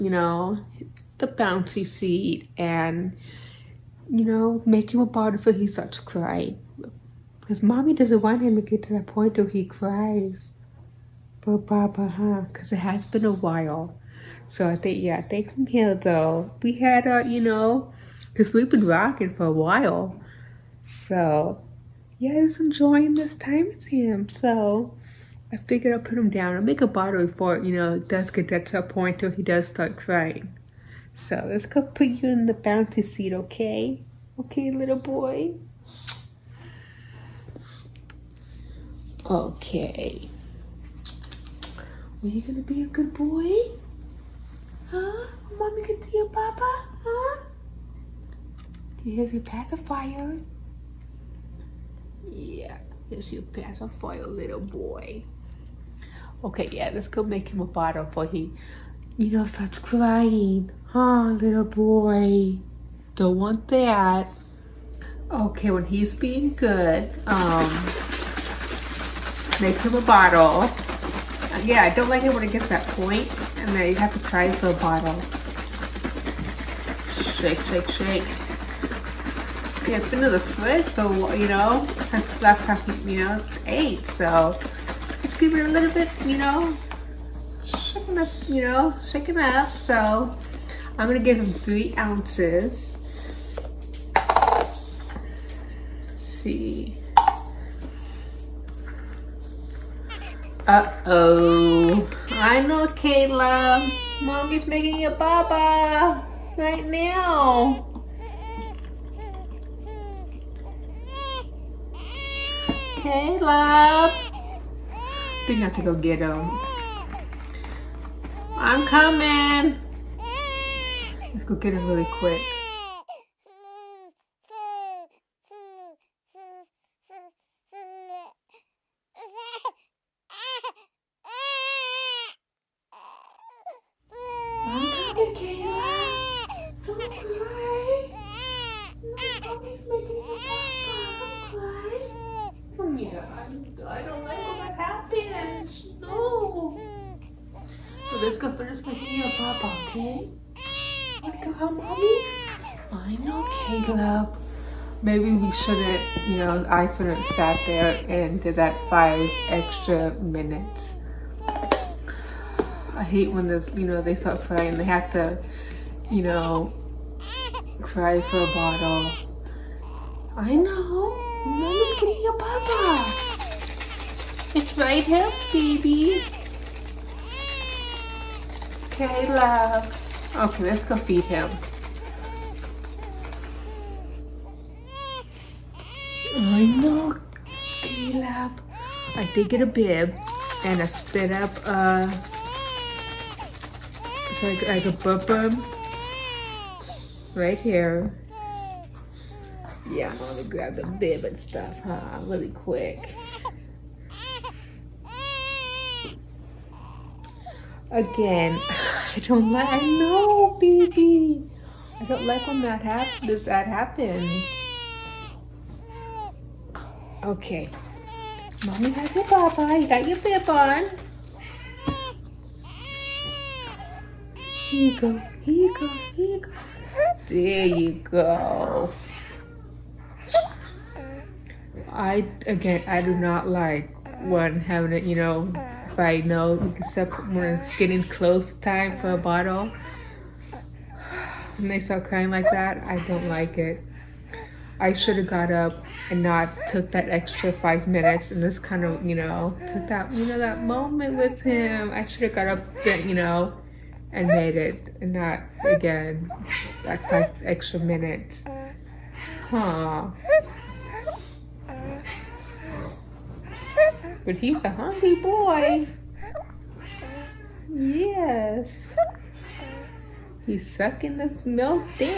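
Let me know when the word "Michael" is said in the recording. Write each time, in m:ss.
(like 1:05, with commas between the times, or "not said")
not said.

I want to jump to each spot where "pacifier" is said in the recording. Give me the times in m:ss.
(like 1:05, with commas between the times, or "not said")
0:49, 0:53.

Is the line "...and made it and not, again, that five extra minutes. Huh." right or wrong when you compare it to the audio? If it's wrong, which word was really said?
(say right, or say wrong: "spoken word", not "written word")
right.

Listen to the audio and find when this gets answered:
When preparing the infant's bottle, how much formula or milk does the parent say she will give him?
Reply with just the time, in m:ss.
1:31.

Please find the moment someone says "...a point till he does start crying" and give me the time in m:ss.
0:28.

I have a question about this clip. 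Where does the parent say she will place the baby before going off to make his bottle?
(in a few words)
bouncy seat.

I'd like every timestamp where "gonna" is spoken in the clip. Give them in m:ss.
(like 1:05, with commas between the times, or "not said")
0:42, 1:31, 3:20.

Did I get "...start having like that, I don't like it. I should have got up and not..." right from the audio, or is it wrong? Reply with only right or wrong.
wrong.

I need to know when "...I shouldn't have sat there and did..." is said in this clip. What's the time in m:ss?
2:36.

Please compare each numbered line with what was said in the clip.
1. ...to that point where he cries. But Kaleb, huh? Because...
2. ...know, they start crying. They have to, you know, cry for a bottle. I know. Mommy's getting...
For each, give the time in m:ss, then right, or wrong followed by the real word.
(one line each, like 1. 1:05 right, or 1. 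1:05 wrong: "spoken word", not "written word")
1. 0:08 wrong: "Baba", not "Kaleb"
2. 2:43 right.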